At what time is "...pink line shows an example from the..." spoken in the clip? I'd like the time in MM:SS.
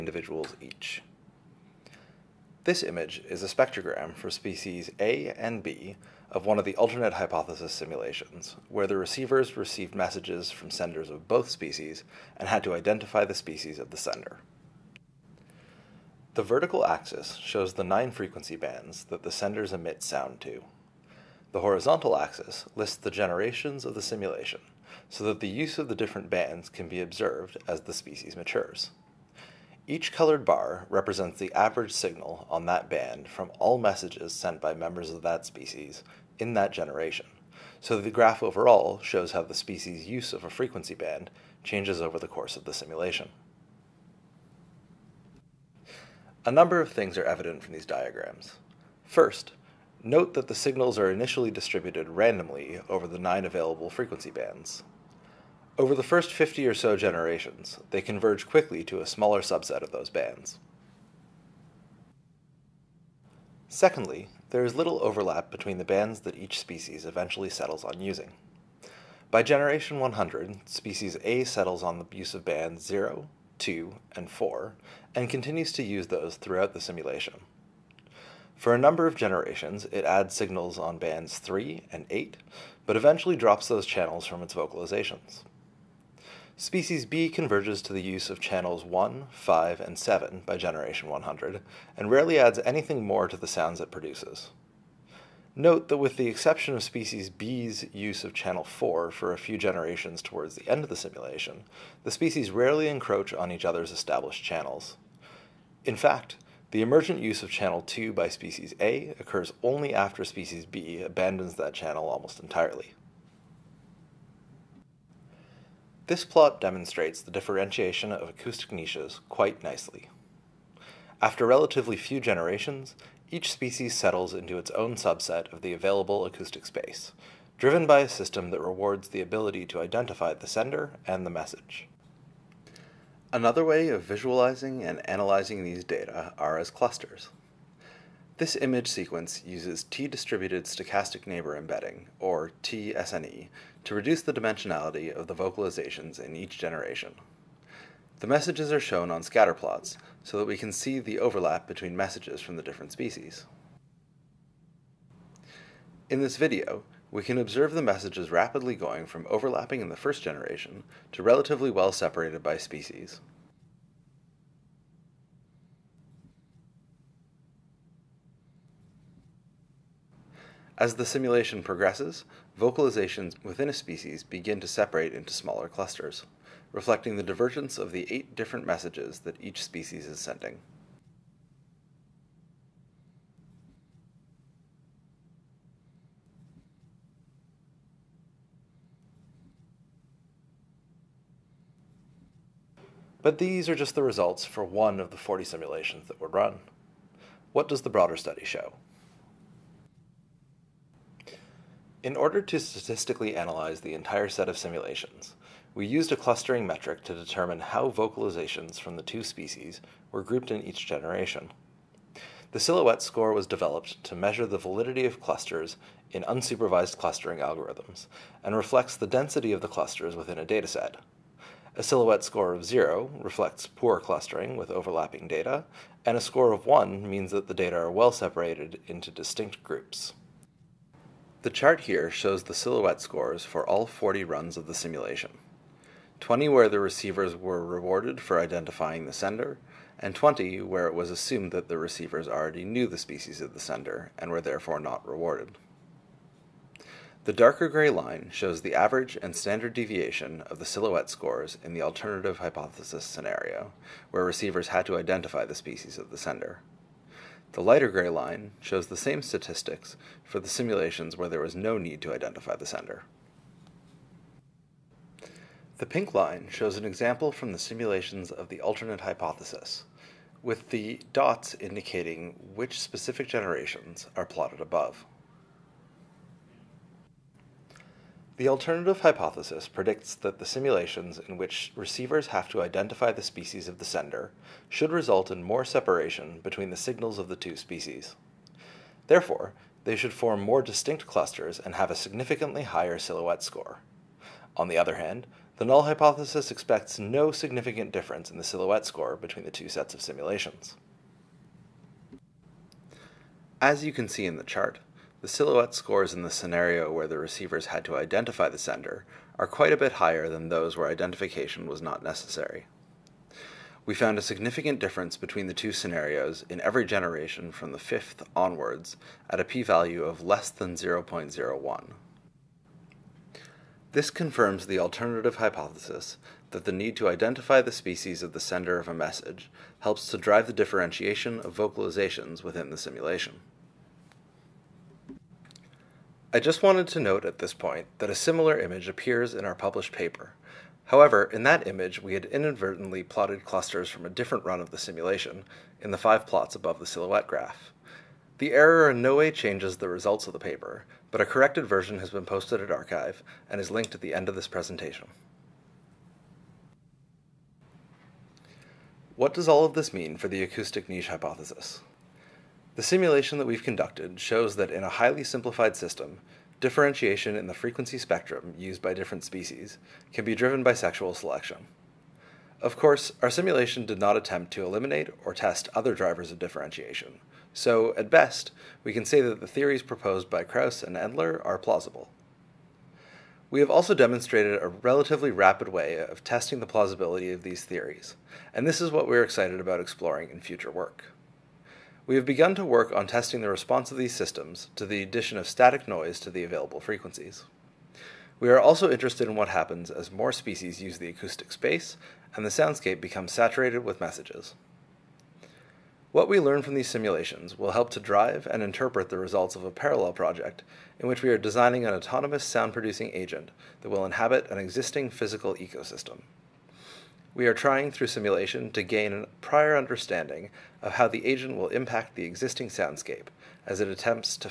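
04:25.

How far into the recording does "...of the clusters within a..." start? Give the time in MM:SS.
03:39.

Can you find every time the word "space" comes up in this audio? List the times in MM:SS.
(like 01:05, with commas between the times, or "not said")
02:06, 06:41.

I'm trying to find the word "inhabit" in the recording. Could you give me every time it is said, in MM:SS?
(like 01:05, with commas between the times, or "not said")
06:54.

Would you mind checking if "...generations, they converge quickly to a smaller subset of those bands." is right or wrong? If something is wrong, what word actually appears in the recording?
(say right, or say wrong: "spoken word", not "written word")
right.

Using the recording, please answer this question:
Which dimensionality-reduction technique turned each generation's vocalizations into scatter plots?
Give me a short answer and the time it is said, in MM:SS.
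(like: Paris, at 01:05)
T-distributed stochastic neighbor embedding, at 02:19.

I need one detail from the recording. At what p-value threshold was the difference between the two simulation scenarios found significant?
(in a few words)
0.01.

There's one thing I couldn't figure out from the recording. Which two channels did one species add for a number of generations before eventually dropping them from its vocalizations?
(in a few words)
3 and 8.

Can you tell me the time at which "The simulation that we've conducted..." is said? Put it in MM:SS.
06:02.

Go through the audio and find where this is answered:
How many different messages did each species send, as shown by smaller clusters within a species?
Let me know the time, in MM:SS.
02:58.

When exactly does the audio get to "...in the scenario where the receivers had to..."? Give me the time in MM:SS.
05:06.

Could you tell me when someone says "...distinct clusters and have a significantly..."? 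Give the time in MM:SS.
04:50.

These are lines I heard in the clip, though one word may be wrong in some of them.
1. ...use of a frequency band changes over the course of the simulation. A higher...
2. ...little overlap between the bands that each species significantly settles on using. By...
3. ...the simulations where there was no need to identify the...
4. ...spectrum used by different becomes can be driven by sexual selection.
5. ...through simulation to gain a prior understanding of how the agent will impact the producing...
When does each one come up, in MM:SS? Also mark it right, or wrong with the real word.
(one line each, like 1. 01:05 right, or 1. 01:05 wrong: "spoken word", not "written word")
1. 00:40 wrong: "number", not "higher"
2. 01:04 wrong: "eventually", not "significantly"
3. 04:20 right
4. 06:07 wrong: "species", not "becomes"
5. 06:57 wrong: "existing", not "producing".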